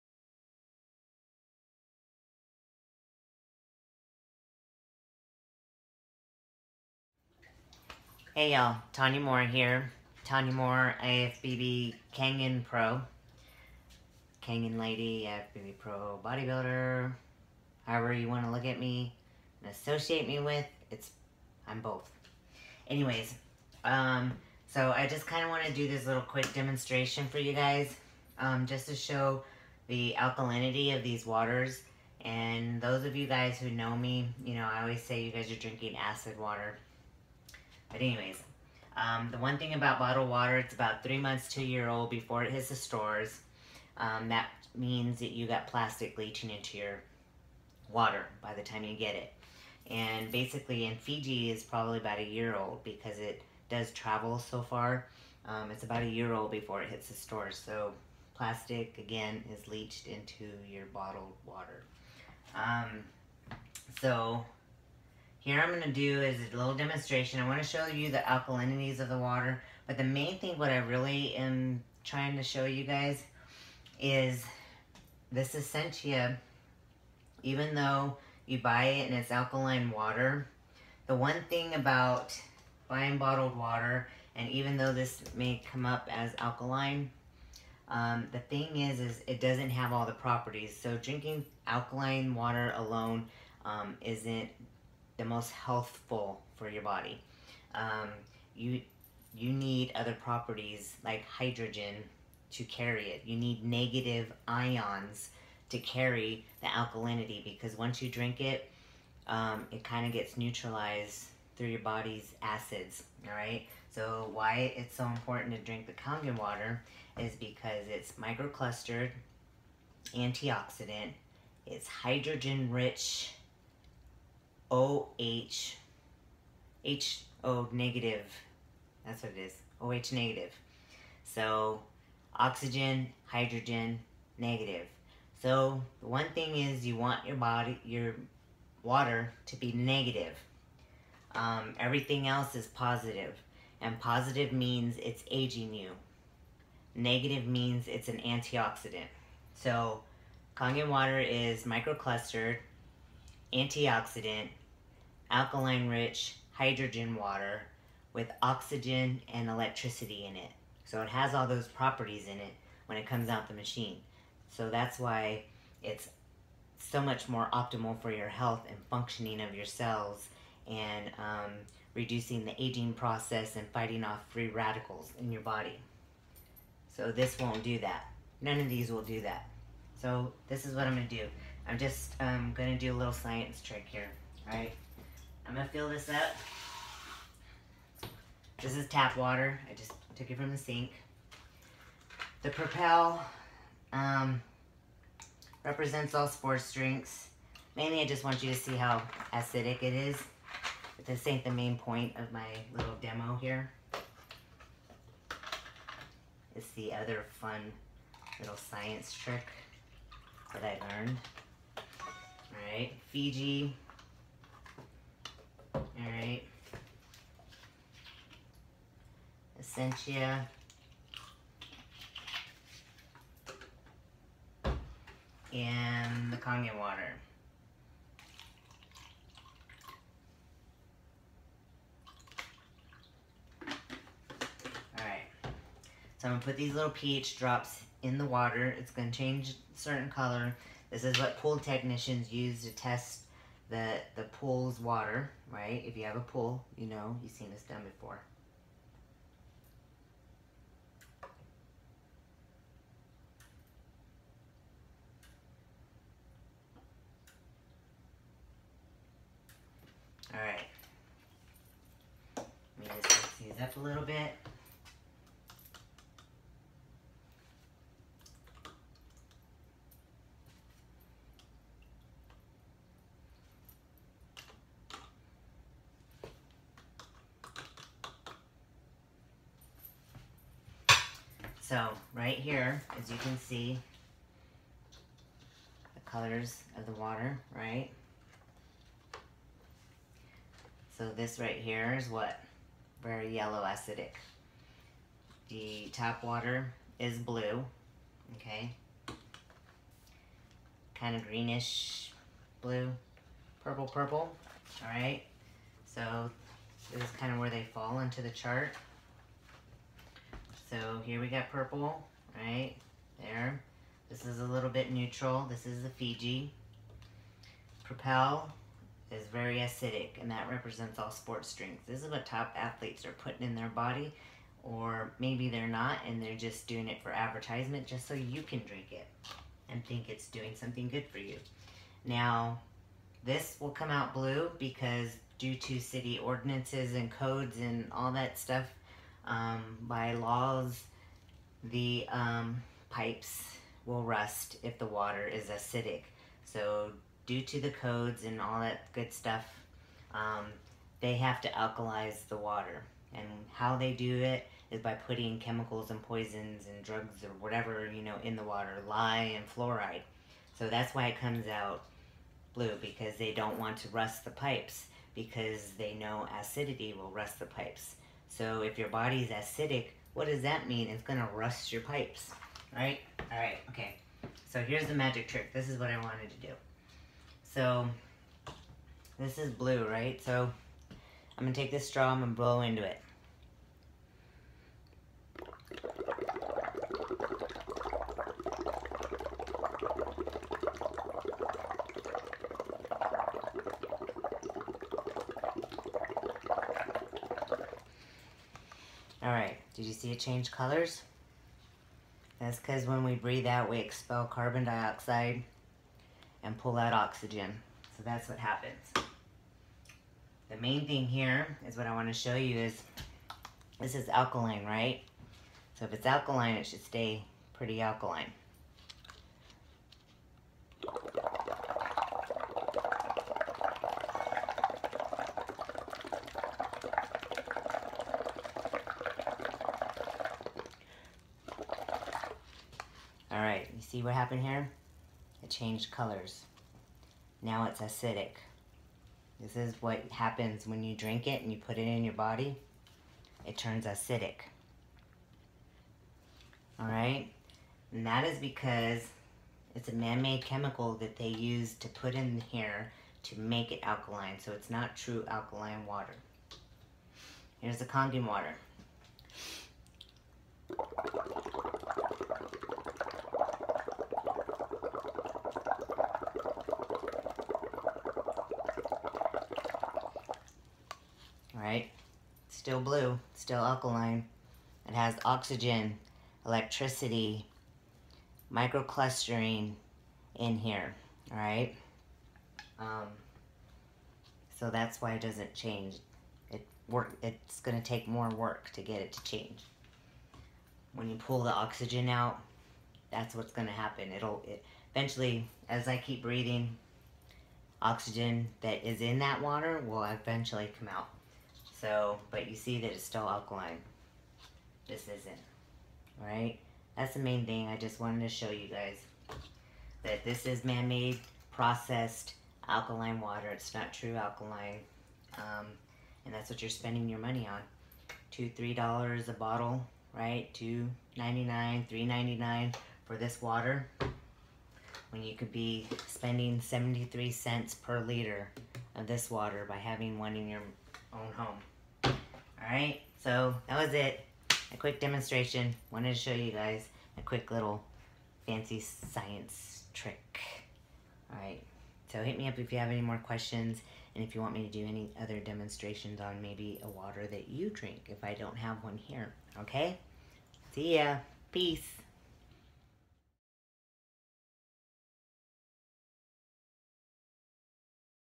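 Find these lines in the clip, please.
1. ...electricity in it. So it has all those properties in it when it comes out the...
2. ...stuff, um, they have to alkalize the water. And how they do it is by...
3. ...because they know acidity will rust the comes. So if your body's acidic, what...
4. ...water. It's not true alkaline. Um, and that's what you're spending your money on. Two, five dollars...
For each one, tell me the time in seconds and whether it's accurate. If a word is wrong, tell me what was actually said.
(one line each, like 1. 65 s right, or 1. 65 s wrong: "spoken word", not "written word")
1. 159 s right
2. 349 s right
3. 365 s wrong: "pipes", not "comes"
4. 513 s wrong: "three", not "five".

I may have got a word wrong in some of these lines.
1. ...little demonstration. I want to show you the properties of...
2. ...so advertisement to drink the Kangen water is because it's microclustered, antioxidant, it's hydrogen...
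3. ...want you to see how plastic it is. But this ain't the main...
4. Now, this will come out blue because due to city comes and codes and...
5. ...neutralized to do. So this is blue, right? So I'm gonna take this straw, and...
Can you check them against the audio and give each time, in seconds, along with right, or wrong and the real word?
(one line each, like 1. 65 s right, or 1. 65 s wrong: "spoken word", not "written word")
1. 66 s wrong: "alkalinities", not "properties"
2. 114 s wrong: "important", not "advertisement"
3. 198 s wrong: "acidic", not "plastic"
4. 332 s wrong: "ordinances", not "comes"
5. 375 s wrong: "wanted", not "neutralized".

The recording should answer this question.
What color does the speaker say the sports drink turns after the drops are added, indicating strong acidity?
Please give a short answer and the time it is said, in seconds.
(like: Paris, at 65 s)
yellow, at 293 s.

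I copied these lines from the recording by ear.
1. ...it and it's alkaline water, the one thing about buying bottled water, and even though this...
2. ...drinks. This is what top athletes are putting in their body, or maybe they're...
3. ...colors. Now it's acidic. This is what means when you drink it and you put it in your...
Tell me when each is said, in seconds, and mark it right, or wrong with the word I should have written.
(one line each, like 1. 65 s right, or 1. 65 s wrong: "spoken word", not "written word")
1. 78 s right
2. 321 s right
3. 435 s wrong: "happens", not "means".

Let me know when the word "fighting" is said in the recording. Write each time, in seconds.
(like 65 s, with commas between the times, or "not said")
173 s.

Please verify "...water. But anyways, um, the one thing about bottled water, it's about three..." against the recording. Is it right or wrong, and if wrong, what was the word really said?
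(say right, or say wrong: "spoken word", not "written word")
right.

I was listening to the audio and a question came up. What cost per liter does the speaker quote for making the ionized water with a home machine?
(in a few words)
73 cents.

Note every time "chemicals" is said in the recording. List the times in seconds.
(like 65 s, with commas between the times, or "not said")
355 s, 450 s.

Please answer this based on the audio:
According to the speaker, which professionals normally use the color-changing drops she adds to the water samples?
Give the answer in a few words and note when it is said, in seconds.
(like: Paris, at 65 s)
pool technicians, at 241 s.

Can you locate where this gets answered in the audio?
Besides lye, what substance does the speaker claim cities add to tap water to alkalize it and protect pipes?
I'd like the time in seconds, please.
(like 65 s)
359 s.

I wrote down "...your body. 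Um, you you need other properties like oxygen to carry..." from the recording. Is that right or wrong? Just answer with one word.
wrong.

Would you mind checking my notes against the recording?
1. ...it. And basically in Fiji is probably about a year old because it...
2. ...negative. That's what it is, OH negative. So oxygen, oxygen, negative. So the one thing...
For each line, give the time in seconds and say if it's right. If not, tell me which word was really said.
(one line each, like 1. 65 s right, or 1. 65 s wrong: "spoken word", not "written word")
1. 49 s right
2. 127 s wrong: "hydrogen", not "oxygen".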